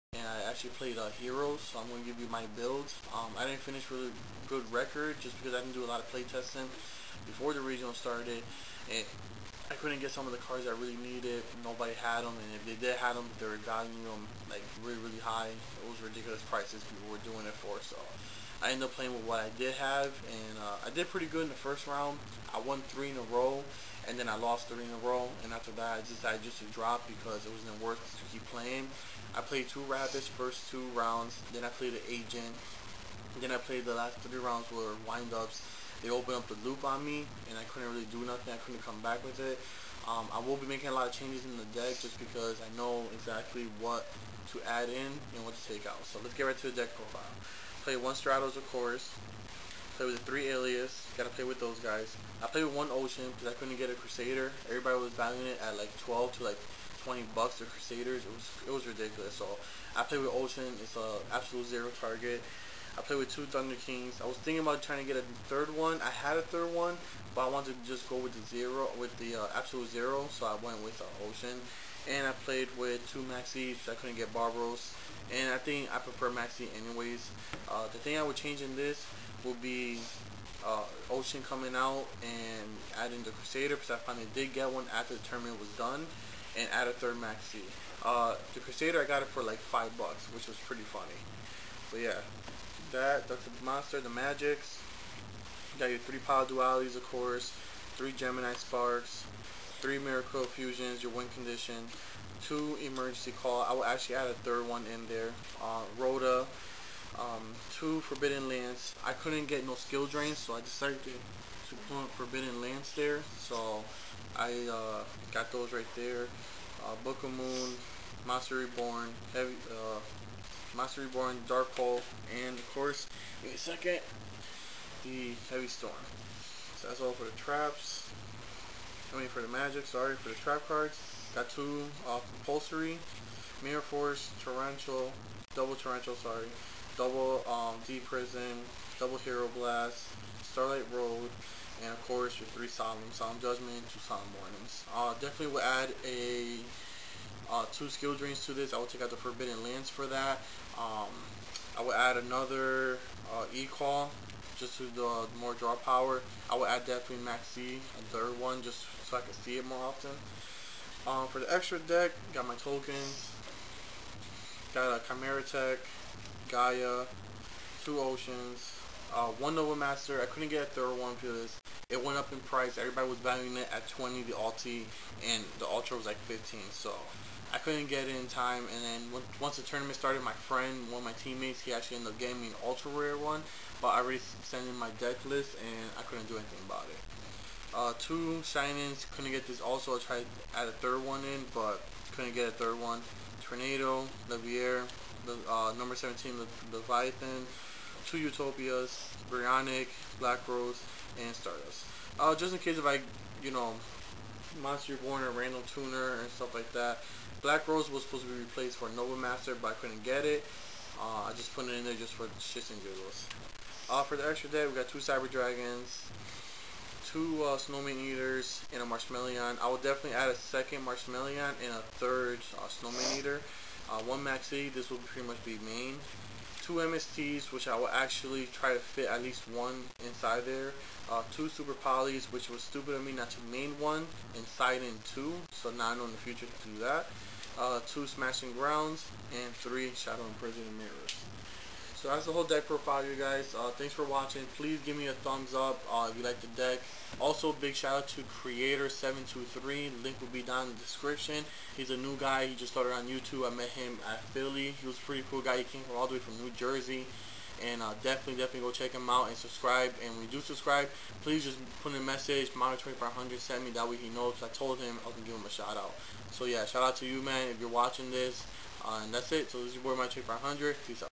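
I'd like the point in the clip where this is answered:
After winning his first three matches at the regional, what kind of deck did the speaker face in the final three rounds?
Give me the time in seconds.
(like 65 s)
35 s.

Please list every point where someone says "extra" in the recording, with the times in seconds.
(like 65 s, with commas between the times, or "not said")
161 s, 214 s.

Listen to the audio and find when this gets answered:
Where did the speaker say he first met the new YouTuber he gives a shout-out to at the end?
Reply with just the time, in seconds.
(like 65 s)
254 s.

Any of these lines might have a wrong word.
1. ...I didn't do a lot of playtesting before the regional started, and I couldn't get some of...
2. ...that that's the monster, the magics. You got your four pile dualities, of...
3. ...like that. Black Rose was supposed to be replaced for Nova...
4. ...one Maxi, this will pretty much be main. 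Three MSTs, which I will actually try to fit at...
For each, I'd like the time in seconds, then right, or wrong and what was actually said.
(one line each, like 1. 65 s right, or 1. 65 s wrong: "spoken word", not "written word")
1. 5 s right
2. 92 s wrong: "three", not "four"
3. 206 s right
4. 224 s wrong: "Two", not "Three".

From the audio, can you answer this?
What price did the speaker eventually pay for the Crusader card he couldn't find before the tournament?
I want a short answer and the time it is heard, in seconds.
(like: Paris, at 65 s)
$5, at 89 s.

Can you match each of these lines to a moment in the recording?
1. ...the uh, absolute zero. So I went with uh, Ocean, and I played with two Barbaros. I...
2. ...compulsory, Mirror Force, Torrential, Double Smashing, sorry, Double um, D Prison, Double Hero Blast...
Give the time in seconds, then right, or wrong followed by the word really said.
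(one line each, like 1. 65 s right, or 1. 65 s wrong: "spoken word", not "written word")
1. 69 s wrong: "Maxis", not "Barbaros"
2. 132 s wrong: "Torrential", not "Smashing".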